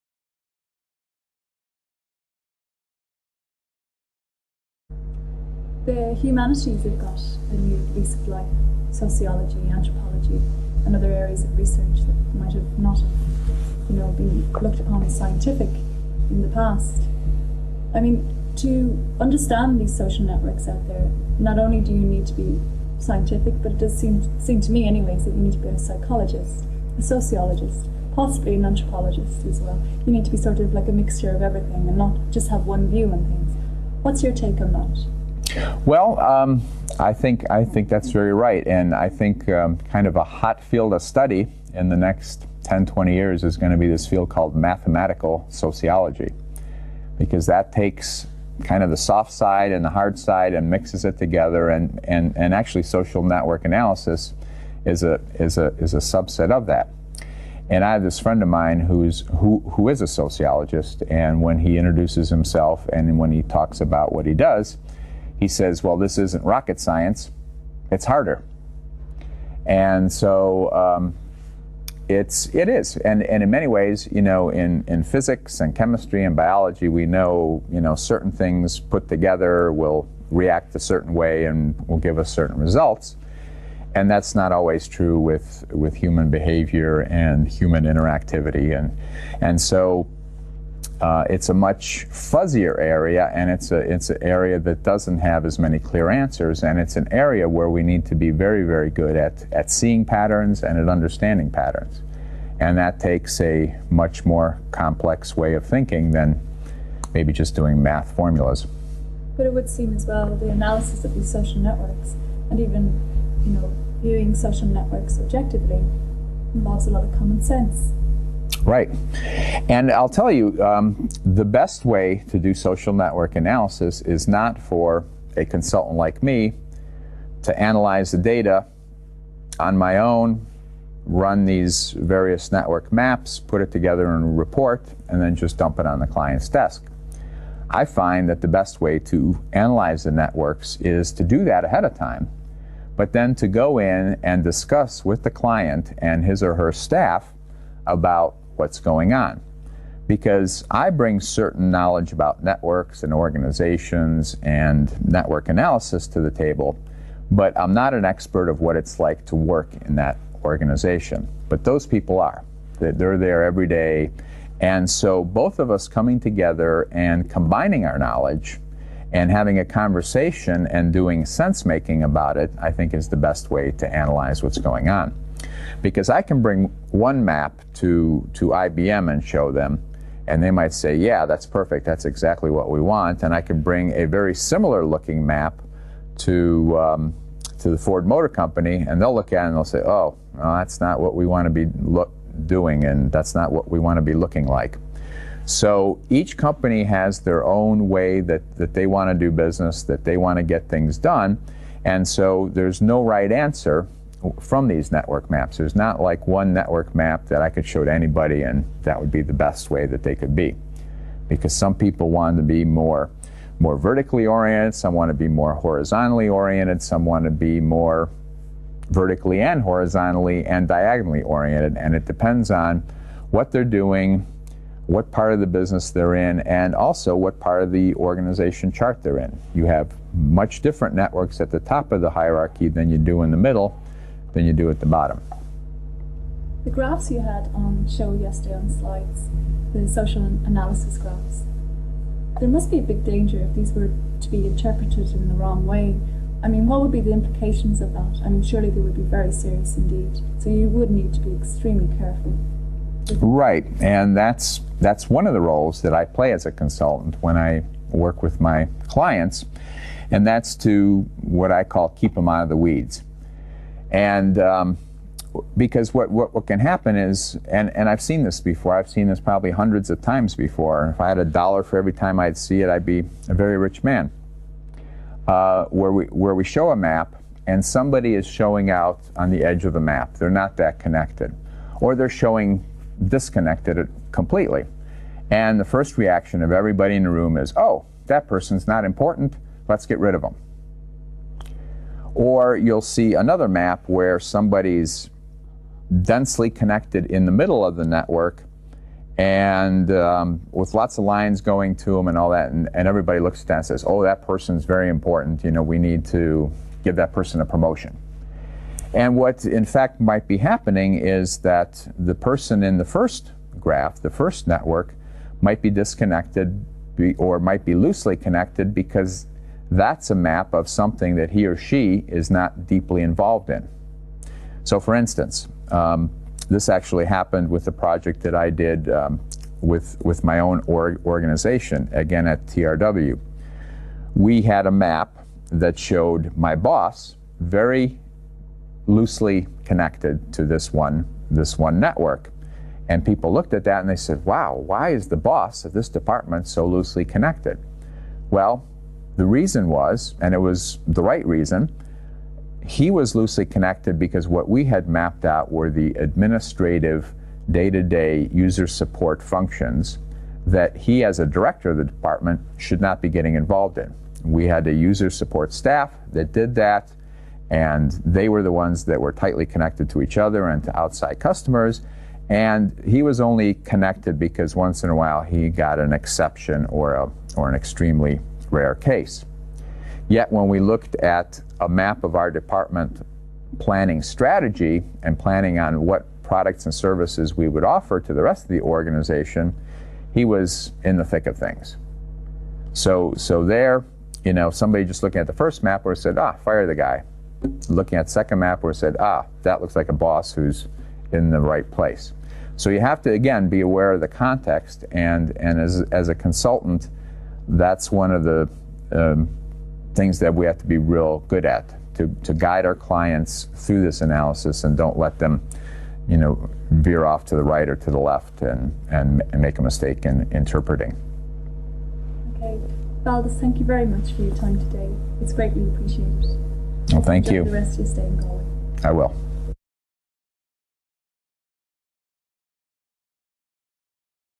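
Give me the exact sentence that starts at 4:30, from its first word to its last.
If I had a dollar for every time I'd see it, I'd be a very rich man.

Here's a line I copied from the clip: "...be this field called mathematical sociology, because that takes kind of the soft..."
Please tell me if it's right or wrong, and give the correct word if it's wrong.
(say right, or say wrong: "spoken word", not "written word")
right.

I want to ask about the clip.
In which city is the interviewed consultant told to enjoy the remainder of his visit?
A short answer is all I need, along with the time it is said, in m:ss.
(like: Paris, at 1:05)
Galway, at 7:08.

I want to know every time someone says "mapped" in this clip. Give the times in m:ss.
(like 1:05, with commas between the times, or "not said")
5:54.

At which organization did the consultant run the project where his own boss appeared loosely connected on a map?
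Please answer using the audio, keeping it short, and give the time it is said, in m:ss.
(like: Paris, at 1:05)
TRW, at 5:32.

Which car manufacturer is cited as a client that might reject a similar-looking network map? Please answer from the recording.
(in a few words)
Ford Motor Company.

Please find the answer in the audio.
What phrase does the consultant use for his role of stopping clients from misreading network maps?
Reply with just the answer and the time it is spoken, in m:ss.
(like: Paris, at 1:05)
keep them out of the weeds, at 4:21.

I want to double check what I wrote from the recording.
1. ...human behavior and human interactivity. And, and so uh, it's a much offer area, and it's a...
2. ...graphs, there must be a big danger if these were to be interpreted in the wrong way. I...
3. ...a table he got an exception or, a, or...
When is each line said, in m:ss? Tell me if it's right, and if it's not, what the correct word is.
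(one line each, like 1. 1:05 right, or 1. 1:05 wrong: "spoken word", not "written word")
1. 1:25 wrong: "fuzzier", not "offer"
2. 4:00 right
3. 6:14 wrong: "while", not "table".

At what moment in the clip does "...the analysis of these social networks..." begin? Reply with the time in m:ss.
1:50.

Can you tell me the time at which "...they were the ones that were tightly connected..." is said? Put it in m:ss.
6:08.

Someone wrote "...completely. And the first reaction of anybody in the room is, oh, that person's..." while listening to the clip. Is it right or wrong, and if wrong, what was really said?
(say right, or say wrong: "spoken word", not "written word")
wrong: "everybody", not "anybody".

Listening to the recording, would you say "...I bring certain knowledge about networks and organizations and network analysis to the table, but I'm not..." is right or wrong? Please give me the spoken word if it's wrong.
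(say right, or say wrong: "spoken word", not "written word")
right.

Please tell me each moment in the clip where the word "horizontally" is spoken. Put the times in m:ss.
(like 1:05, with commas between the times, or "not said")
3:35, 3:39.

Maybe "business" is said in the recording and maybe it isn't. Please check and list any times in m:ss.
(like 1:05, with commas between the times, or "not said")
3:19, 3:45.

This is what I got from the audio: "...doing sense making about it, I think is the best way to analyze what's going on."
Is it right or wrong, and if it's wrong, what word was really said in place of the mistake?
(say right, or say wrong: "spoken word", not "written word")
right.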